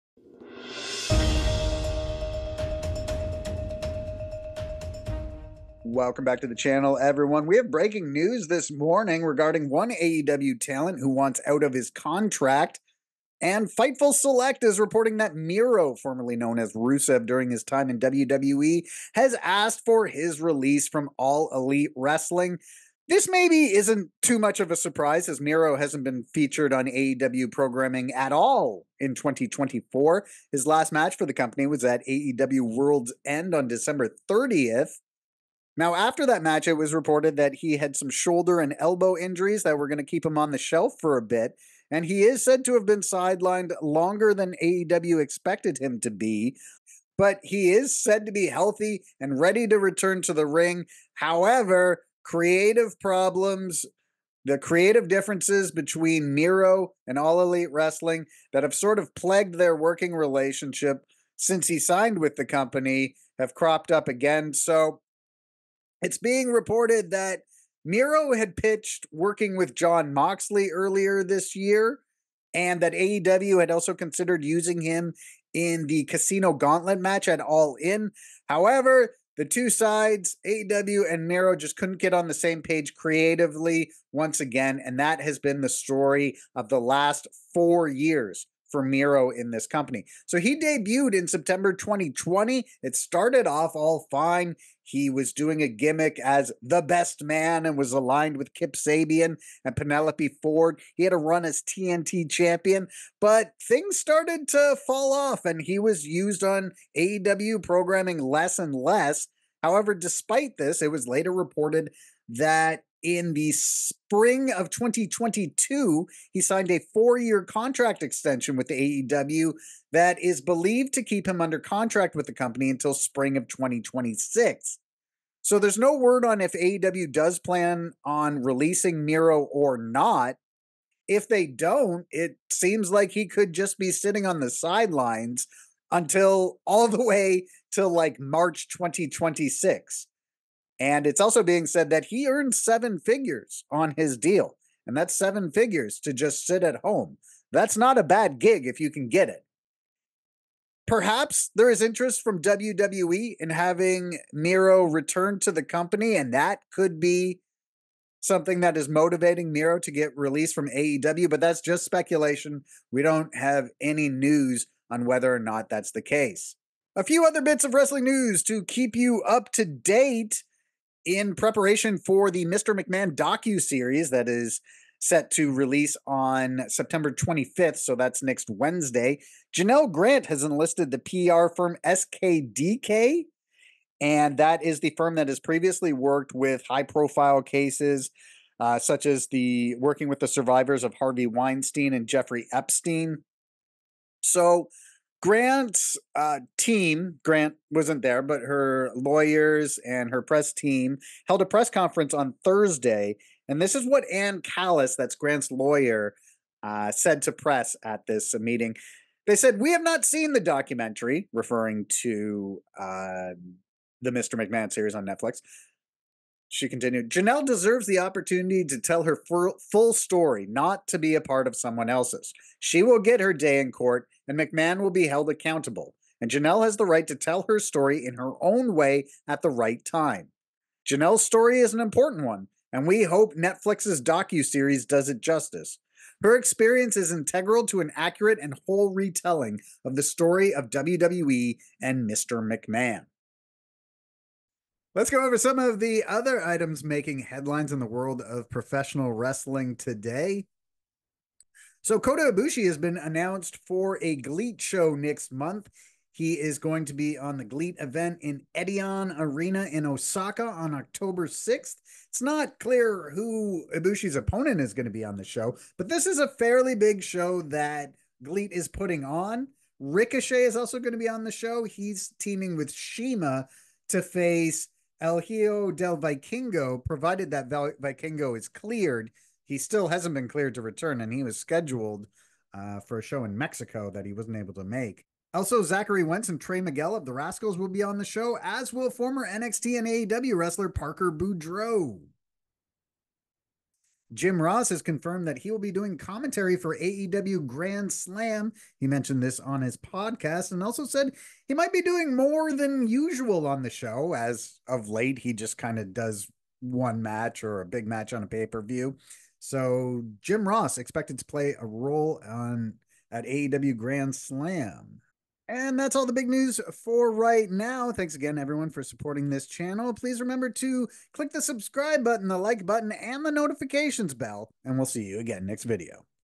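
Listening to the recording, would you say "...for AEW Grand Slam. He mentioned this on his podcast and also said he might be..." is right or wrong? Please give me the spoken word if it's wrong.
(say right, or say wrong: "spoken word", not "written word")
right.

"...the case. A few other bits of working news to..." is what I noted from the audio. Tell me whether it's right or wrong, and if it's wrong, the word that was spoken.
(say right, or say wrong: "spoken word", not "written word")
wrong: "wrestling", not "working".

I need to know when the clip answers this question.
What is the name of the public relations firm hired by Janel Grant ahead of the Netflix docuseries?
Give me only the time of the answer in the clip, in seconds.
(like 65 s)
181 s.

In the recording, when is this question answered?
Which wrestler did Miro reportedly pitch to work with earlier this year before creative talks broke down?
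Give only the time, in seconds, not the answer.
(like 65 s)
69 s.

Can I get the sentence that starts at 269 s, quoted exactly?
Ricochet is also going to be on the show.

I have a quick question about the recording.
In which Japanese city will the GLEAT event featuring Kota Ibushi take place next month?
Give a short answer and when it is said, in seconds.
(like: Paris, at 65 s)
Osaka, at 259 s.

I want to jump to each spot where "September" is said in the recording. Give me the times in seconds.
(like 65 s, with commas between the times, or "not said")
91 s, 176 s.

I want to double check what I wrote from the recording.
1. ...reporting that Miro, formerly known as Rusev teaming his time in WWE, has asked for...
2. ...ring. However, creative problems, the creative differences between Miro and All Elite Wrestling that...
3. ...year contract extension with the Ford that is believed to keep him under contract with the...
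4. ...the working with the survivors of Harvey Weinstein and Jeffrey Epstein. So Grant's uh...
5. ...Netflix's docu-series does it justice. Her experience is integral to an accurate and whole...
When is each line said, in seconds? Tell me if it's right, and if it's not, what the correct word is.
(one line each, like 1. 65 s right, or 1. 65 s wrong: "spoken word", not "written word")
1. 14 s wrong: "during", not "teaming"
2. 50 s right
3. 117 s wrong: "AEW", not "Ford"
4. 189 s right
5. 233 s right.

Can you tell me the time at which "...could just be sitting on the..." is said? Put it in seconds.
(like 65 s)
133 s.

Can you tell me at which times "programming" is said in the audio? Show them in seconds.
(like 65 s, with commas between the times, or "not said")
27 s, 107 s.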